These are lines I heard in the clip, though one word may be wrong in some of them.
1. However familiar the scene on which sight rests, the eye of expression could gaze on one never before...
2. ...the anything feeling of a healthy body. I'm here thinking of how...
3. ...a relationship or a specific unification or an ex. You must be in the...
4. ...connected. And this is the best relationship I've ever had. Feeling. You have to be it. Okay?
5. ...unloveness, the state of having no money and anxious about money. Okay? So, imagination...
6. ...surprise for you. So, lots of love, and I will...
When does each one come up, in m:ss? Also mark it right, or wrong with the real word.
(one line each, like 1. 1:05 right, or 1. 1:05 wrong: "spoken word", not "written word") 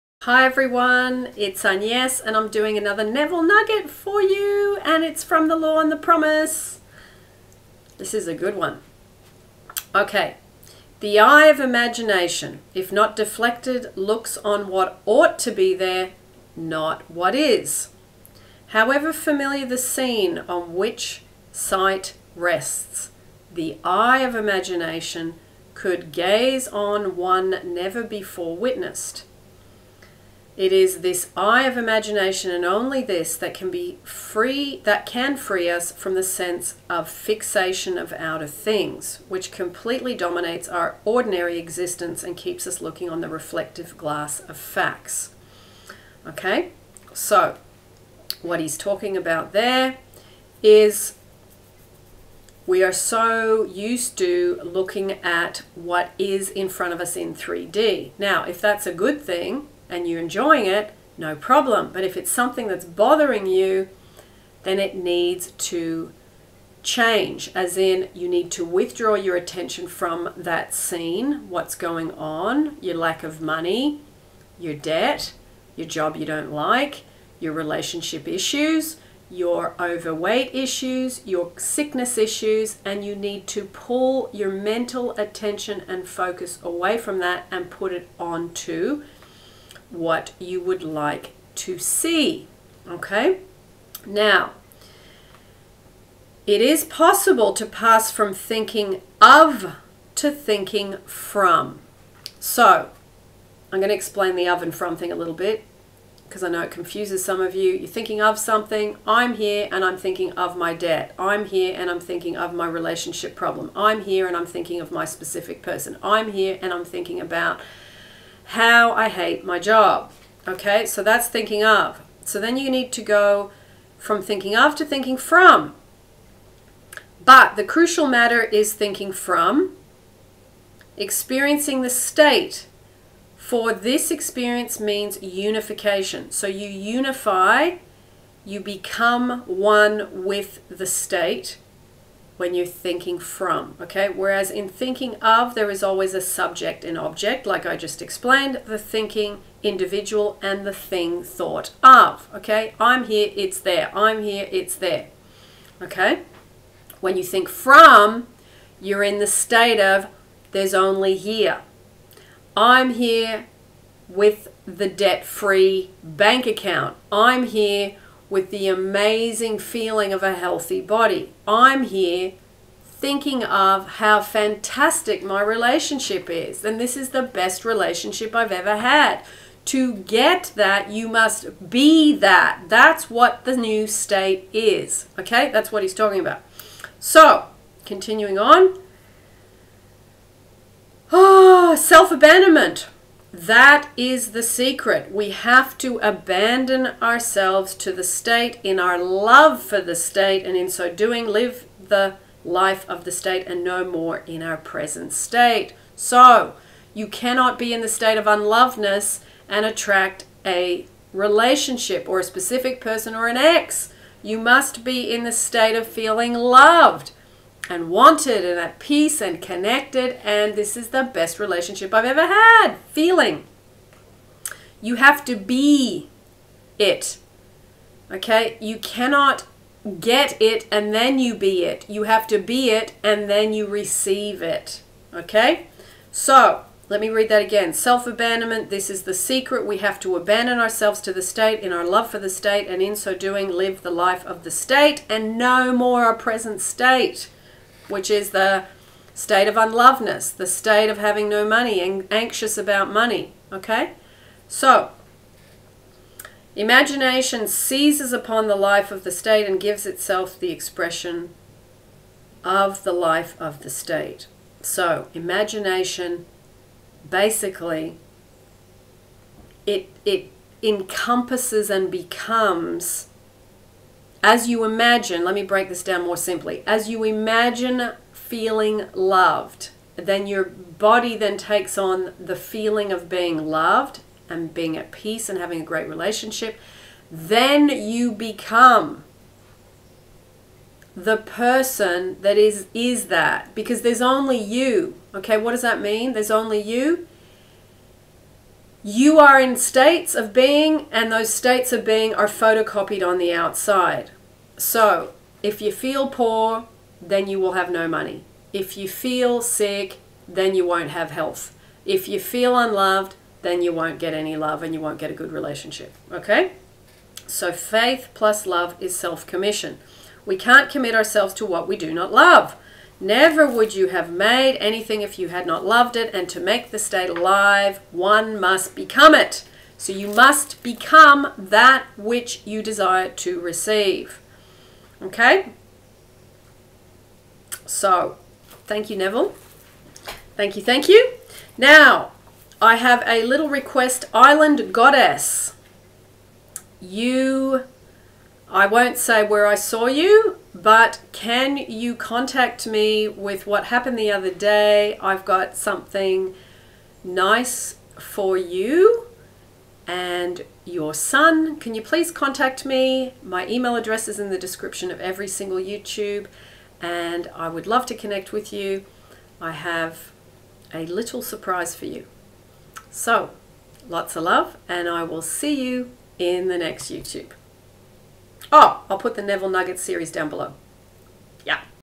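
1. 0:18 wrong: "imagination", not "expression"
2. 2:48 wrong: "amazing", not "anything"
3. 3:30 wrong: "person", not "unification"
4. 3:39 right
5. 4:09 right
6. 6:11 right.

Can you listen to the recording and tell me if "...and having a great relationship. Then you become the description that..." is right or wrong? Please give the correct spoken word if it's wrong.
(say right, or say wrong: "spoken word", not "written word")
wrong: "person", not "description".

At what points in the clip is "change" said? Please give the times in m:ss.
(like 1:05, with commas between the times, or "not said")
1:06.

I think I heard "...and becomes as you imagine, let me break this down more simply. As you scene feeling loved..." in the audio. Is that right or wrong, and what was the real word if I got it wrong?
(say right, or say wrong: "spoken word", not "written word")
wrong: "imagine", not "scene".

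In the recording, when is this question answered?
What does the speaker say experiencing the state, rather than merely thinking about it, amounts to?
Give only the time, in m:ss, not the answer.
2:15.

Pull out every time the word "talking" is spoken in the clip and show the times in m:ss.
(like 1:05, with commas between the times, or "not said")
0:48, 3:05.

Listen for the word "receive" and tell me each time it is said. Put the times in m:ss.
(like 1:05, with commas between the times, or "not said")
3:53, 5:33.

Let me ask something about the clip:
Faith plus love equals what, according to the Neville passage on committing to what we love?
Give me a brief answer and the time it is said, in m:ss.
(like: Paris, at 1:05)
self commission, at 5:18.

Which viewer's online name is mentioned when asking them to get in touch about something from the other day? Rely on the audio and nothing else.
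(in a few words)
Island Goddess.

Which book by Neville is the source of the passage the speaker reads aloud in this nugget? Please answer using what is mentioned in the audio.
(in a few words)
The Law and the Promise.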